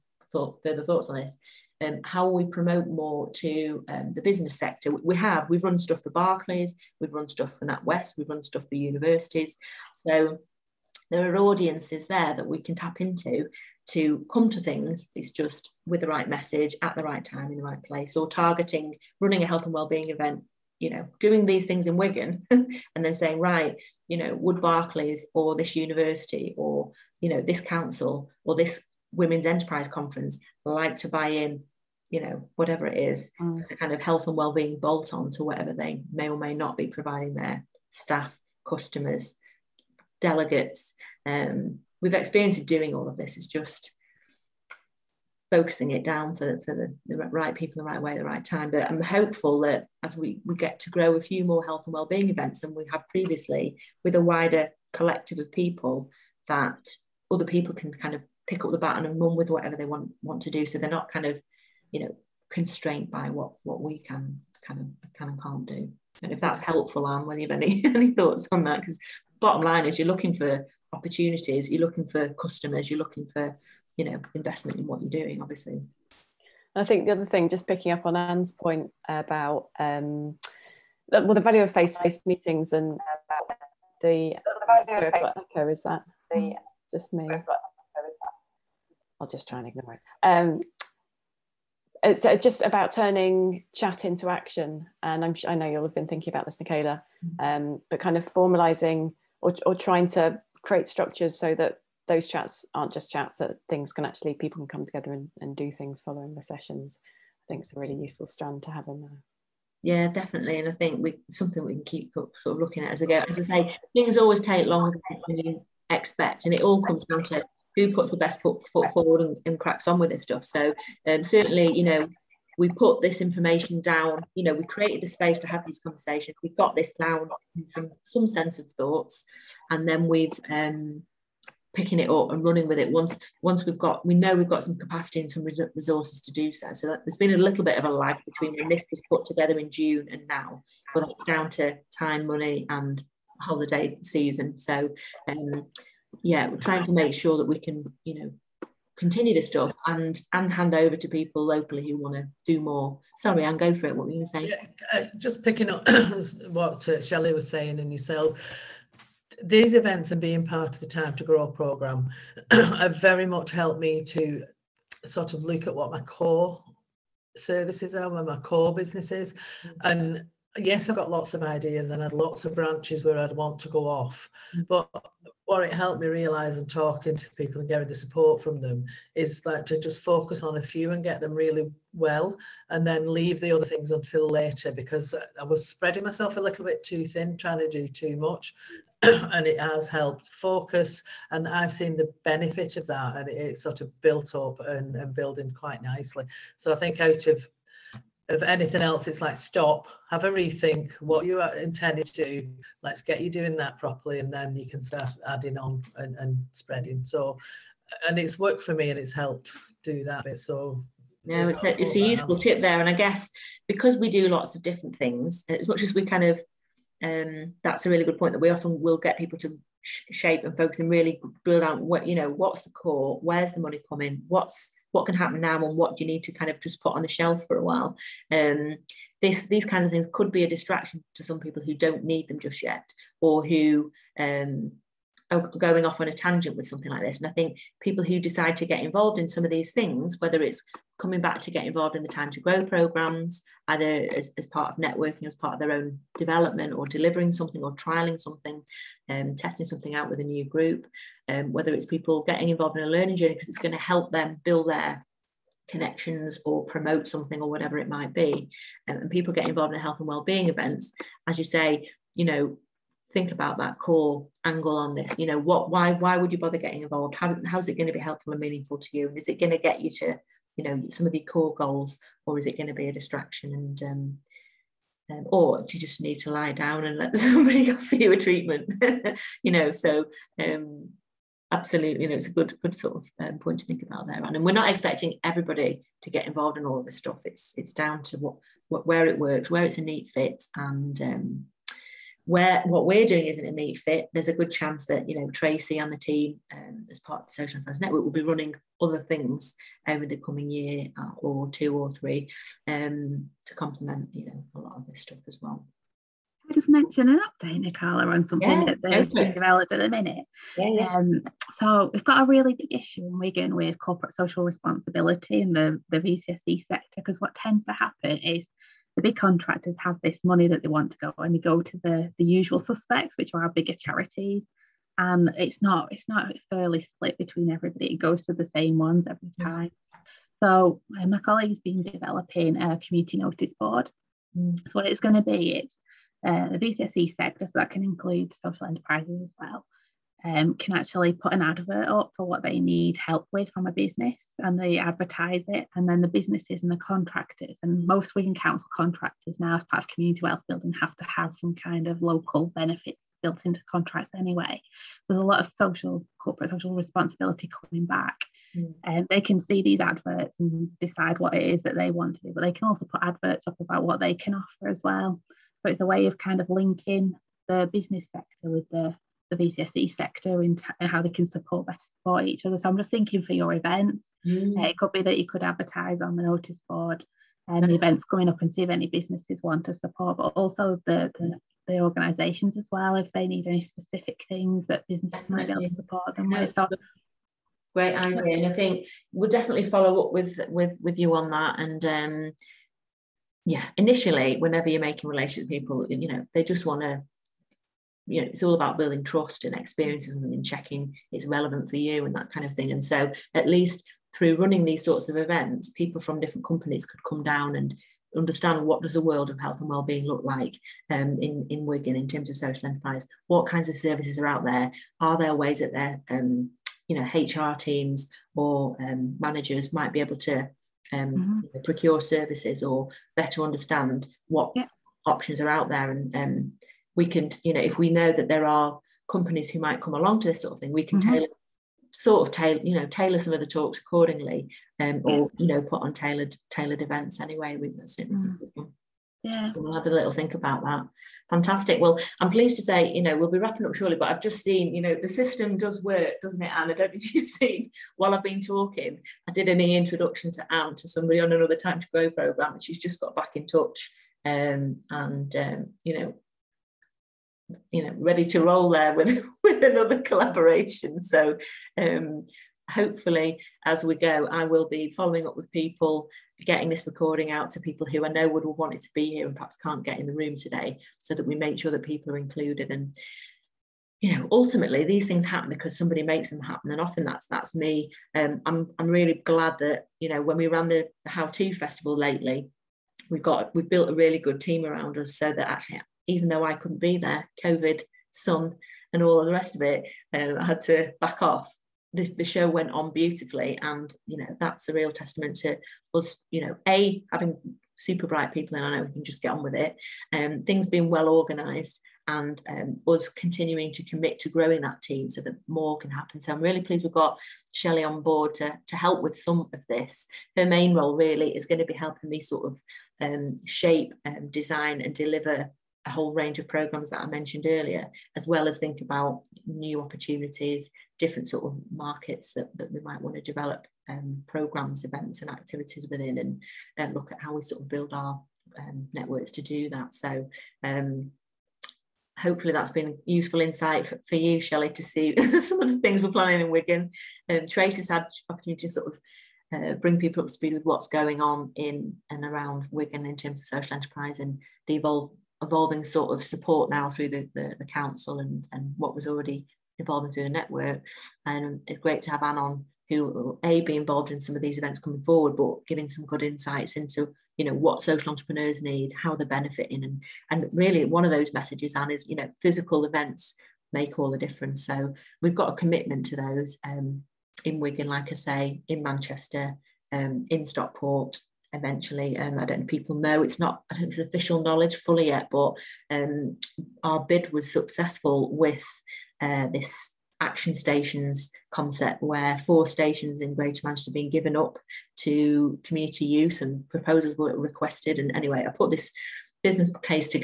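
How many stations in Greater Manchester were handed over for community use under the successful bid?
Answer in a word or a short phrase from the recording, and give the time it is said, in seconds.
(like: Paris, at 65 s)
4, at 582 s.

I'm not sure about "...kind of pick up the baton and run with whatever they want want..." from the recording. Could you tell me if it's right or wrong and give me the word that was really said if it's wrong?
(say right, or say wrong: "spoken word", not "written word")
right.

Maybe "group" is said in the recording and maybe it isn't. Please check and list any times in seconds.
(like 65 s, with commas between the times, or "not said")
250 s.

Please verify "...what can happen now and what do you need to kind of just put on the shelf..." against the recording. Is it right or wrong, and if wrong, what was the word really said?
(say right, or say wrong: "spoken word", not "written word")
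right.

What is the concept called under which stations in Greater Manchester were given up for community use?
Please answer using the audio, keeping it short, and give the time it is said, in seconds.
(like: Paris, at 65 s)
Action Stations, at 580 s.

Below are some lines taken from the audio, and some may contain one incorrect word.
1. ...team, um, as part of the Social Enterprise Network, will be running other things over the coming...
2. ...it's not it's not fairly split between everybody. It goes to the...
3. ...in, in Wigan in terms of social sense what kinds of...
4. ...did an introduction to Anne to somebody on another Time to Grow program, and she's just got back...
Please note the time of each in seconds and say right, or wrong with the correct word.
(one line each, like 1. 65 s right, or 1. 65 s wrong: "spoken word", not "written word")
1. 295 s right
2. 325 s right
3. 411 s wrong: "enterprise", not "sense"
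4. 449 s right.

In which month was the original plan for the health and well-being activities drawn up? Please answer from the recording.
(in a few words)
June.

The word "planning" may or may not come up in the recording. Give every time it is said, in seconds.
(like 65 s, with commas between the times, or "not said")
536 s.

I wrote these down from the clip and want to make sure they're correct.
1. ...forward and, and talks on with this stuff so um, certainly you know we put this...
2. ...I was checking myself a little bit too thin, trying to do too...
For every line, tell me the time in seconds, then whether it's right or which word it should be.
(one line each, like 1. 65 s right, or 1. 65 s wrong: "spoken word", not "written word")
1. 118 s wrong: "cracks", not "talks"
2. 185 s wrong: "spreading", not "checking".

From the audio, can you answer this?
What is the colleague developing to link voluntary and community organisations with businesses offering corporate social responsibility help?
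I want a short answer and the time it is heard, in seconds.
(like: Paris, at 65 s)
A community notice board, at 332 s.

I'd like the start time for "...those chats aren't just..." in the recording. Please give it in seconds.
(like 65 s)
102 s.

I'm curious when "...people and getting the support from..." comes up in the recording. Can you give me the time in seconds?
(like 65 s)
177 s.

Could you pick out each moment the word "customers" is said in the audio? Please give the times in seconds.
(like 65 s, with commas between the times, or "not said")
38 s, 72 s.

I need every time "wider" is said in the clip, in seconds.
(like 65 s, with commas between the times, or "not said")
54 s.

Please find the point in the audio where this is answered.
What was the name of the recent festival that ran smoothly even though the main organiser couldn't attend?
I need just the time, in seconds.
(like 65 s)
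481 s.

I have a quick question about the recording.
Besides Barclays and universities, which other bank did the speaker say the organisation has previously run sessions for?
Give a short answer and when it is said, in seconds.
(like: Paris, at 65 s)
NatWest, at 7 s.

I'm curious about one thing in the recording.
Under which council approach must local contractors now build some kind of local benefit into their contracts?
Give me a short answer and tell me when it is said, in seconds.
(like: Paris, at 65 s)
Community wealth building, at 349 s.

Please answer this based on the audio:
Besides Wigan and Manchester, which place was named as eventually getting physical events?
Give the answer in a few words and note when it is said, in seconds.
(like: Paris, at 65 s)
Stockport, at 570 s.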